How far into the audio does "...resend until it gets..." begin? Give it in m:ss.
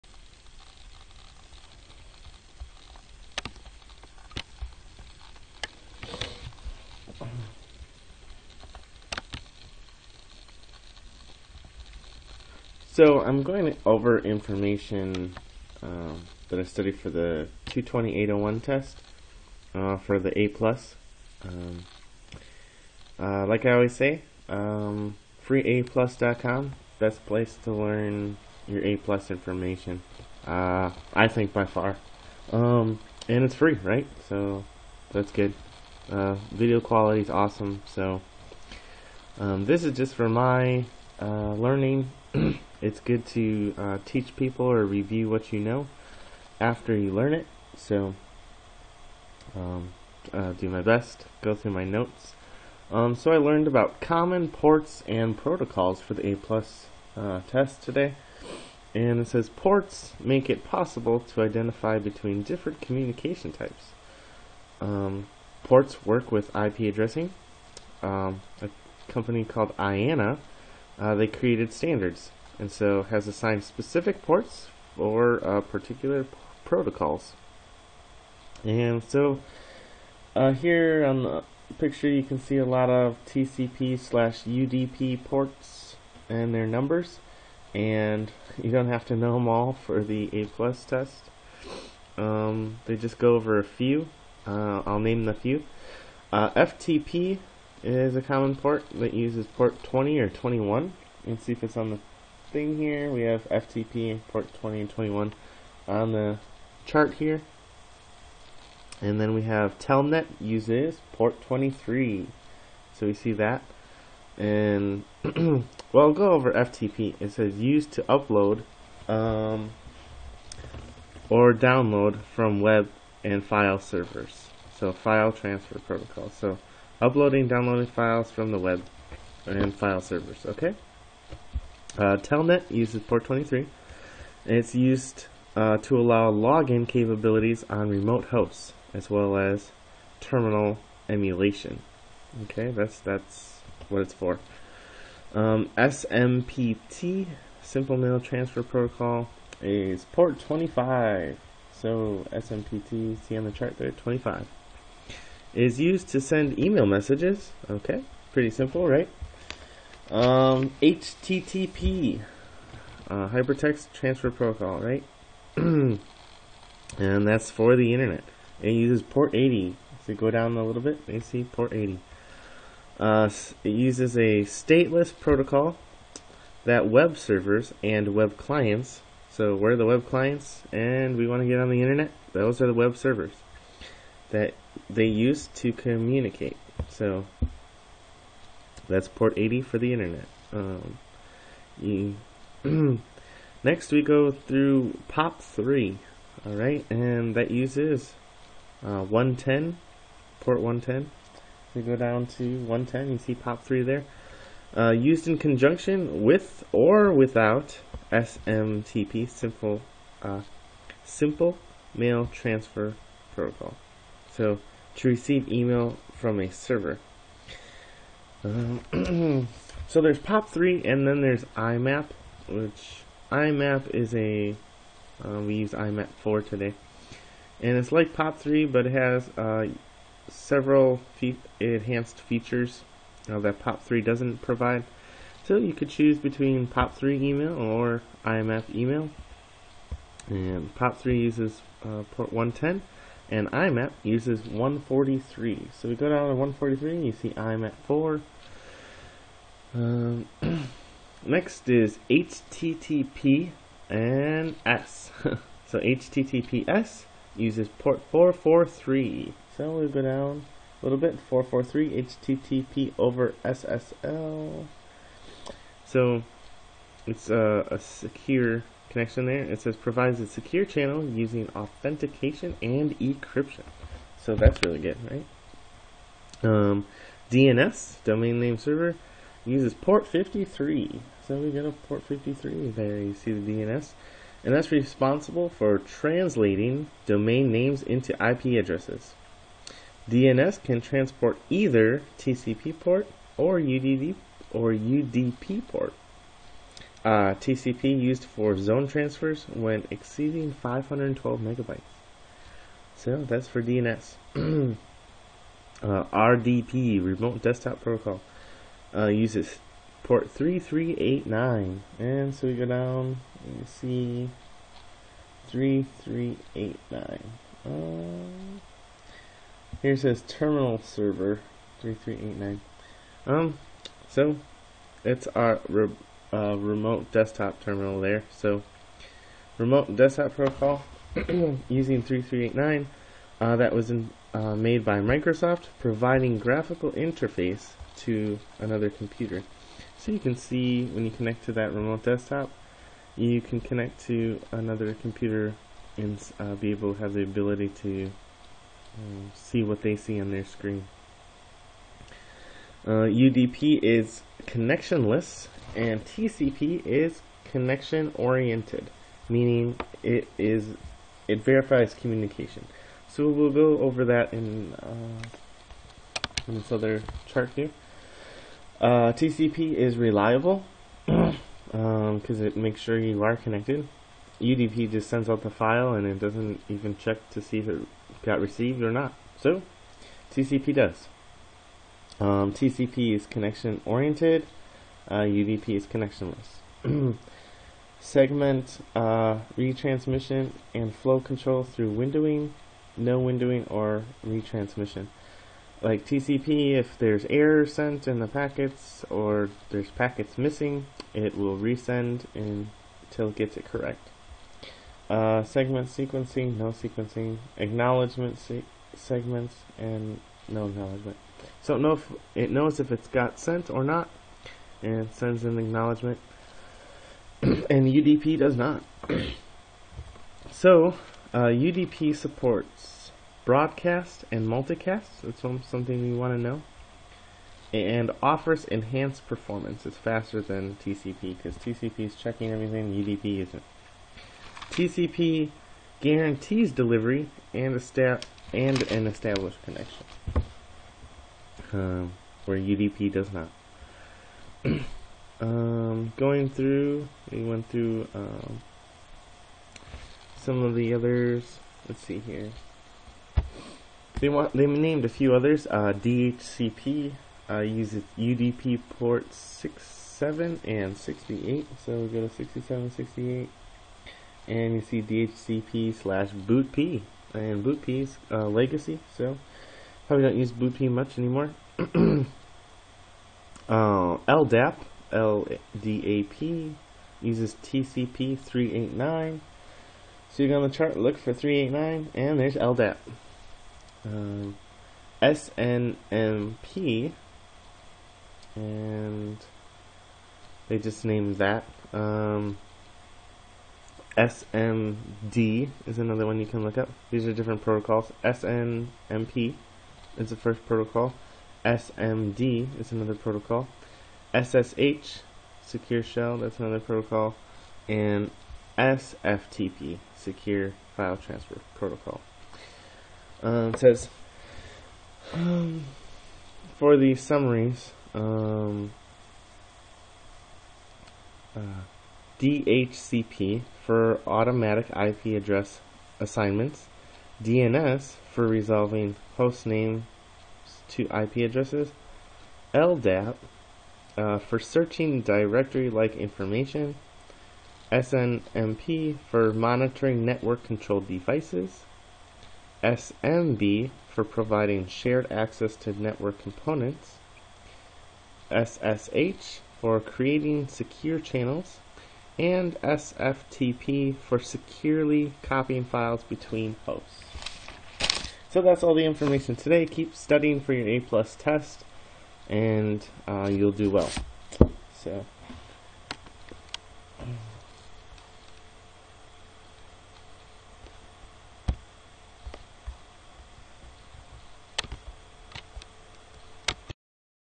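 6:41.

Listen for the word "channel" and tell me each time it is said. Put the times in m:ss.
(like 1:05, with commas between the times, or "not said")
4:30, 9:11.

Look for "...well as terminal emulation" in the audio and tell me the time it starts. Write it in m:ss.
2:19.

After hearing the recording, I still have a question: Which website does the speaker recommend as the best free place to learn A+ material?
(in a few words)
freeaplus.com.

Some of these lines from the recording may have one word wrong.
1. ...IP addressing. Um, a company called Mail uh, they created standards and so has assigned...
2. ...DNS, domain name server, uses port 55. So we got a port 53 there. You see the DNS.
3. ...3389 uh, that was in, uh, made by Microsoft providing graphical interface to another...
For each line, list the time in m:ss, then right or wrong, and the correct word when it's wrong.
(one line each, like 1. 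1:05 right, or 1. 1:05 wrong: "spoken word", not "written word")
1. 1:06 wrong: "IANA", not "Mail"
2. 4:37 wrong: "53", not "55"
3. 5:32 right.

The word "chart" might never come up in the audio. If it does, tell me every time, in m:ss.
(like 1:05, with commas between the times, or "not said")
1:46, 2:33, 6:07, 8:00.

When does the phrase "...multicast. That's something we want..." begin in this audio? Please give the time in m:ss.
7:04.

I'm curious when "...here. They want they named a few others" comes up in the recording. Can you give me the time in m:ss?
7:32.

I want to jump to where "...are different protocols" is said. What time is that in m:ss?
8:17.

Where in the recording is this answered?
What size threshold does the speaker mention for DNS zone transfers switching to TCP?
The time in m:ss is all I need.
5:00.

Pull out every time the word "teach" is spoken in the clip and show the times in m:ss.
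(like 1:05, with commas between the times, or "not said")
0:44.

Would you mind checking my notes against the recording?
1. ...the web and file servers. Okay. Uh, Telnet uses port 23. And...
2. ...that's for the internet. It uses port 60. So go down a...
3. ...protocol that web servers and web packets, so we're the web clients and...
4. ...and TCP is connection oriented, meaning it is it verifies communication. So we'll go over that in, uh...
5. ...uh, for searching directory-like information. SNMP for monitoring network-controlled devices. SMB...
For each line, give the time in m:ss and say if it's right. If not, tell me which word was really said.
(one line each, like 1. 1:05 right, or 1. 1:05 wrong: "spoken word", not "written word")
1. 2:08 right
2. 2:46 wrong: "80", not "60"
3. 2:55 wrong: "clients", not "packets"
4. 5:55 right
5. 8:54 right.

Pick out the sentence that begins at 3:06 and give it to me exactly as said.
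So that's port 80 for the internet.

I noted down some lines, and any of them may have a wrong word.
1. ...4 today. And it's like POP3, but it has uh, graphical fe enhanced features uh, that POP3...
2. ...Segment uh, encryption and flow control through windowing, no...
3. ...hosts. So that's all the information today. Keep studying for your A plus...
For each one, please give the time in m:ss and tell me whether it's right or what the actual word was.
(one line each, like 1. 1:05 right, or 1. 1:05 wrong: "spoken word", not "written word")
1. 3:46 wrong: "several", not "graphical"
2. 6:27 wrong: "retransmission", not "encryption"
3. 9:16 right.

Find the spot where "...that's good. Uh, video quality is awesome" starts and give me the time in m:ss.
0:35.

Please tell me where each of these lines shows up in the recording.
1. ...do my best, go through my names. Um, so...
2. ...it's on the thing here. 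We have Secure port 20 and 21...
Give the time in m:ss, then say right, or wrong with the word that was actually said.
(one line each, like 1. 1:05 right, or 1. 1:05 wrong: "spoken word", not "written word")
1. 0:50 wrong: "notes", not "names"
2. 1:41 wrong: "FTP", not "Secure".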